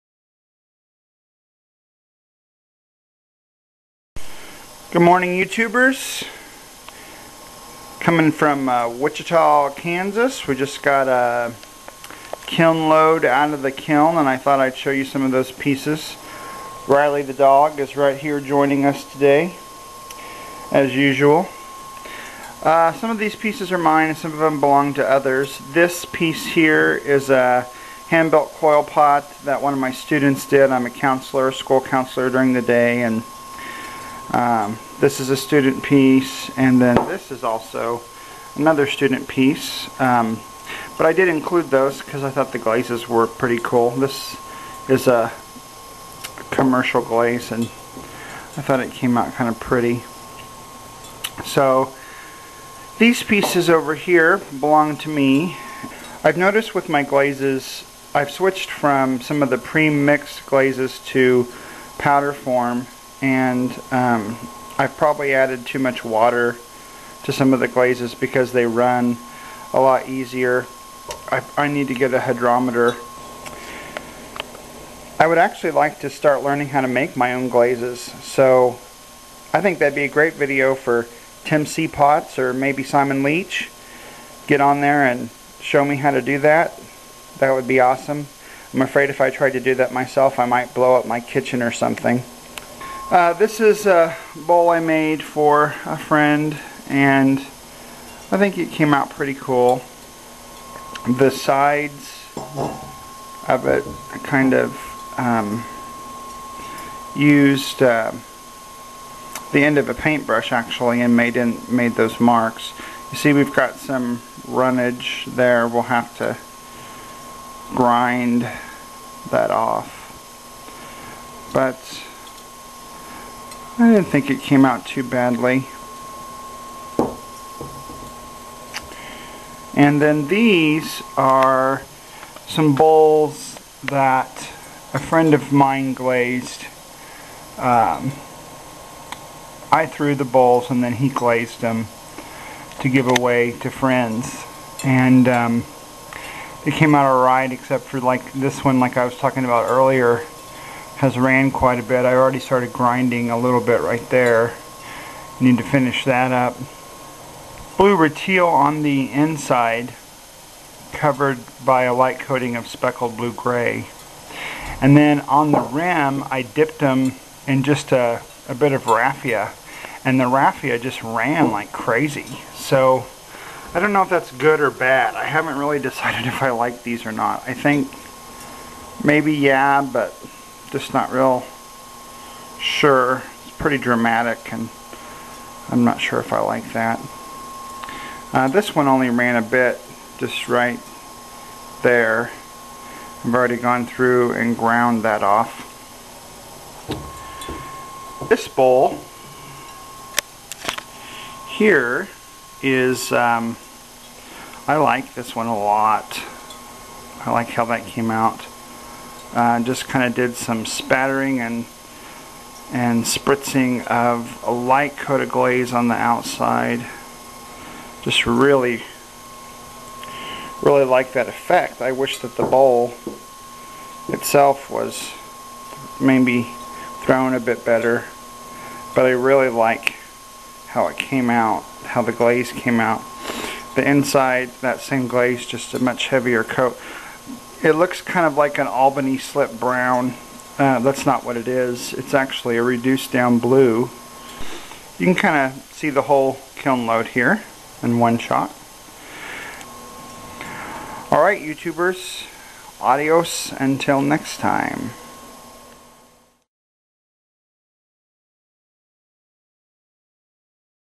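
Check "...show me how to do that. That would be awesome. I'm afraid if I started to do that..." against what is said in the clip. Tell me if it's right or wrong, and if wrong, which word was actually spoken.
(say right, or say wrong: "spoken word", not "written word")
wrong: "tried", not "started".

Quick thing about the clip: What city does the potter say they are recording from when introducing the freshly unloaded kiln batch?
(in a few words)
Wichita, Kansas.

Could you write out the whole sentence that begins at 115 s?
We'll have to grind that off.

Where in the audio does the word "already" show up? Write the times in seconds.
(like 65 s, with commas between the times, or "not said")
152 s, 193 s.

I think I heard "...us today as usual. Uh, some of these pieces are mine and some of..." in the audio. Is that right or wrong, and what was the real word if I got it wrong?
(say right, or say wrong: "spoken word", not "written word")
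right.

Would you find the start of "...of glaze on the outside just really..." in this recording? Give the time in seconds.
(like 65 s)
215 s.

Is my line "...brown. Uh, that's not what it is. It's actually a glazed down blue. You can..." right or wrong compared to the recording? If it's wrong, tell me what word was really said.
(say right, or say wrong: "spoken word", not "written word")
wrong: "reduced", not "glazed".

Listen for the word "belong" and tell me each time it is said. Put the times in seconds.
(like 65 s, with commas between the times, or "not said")
24 s, 54 s.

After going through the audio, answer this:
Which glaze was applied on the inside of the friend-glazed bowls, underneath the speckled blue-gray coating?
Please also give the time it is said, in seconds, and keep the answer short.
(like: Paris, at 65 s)
Blue rutile, at 157 s.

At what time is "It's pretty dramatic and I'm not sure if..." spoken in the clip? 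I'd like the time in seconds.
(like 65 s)
183 s.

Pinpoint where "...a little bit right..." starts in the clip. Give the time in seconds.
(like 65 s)
153 s.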